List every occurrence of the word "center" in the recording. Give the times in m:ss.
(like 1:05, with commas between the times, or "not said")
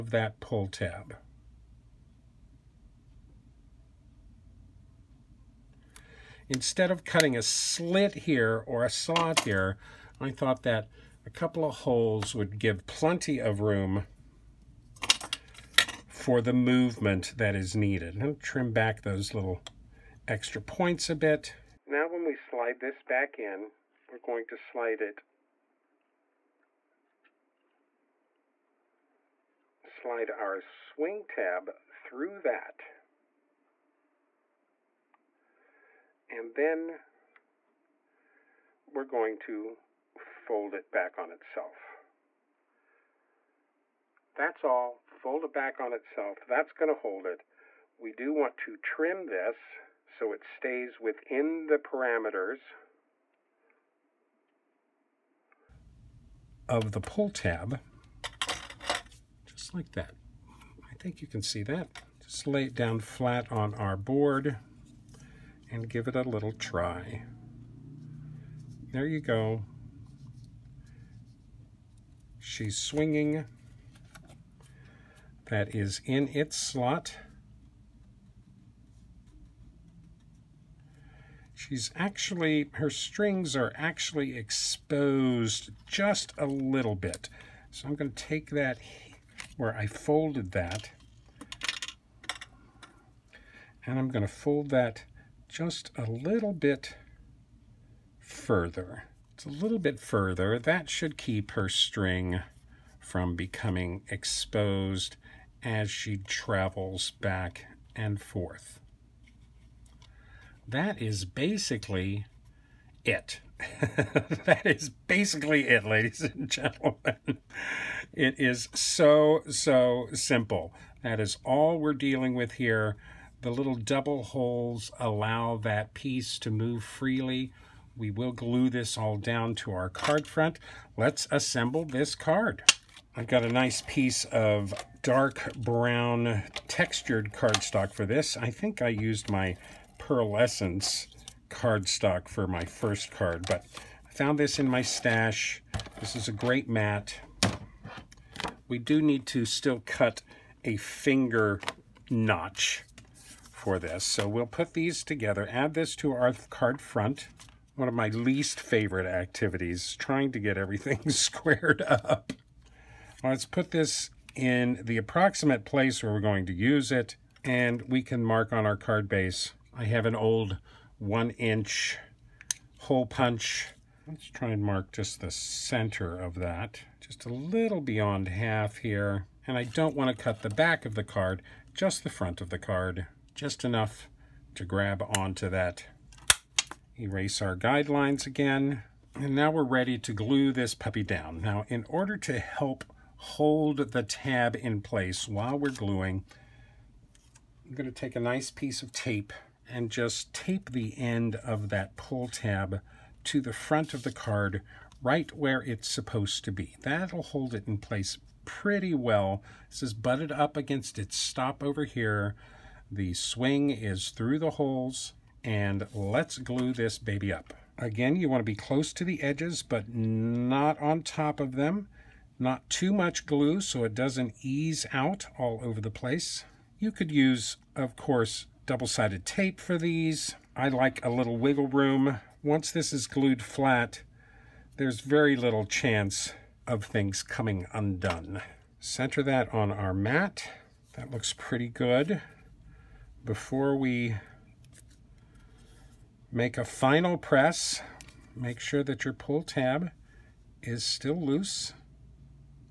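2:55, 3:58.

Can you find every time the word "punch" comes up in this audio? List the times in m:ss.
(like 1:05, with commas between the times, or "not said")
2:53.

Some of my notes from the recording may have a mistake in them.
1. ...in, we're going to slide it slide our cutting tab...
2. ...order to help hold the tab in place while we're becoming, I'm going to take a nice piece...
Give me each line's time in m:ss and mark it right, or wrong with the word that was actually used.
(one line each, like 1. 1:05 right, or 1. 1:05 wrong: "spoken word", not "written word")
1. 0:23 wrong: "swing", not "cutting"
2. 3:11 wrong: "gluing", not "becoming".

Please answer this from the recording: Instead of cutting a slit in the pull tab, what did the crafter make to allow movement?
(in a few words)
a couple of holes.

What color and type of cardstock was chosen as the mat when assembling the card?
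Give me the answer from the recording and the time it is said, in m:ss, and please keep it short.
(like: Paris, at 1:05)
dark brown textured, at 2:15.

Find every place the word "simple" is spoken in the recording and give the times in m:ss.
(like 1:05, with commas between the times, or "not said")
2:00.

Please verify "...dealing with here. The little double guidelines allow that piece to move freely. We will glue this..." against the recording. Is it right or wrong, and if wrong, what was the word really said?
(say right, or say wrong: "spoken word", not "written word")
wrong: "holes", not "guidelines".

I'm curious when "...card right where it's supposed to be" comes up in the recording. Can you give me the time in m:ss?
3:24.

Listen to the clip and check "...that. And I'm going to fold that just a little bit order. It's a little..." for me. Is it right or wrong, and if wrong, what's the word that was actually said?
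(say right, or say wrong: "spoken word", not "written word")
wrong: "further", not "order".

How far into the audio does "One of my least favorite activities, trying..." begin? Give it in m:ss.
2:37.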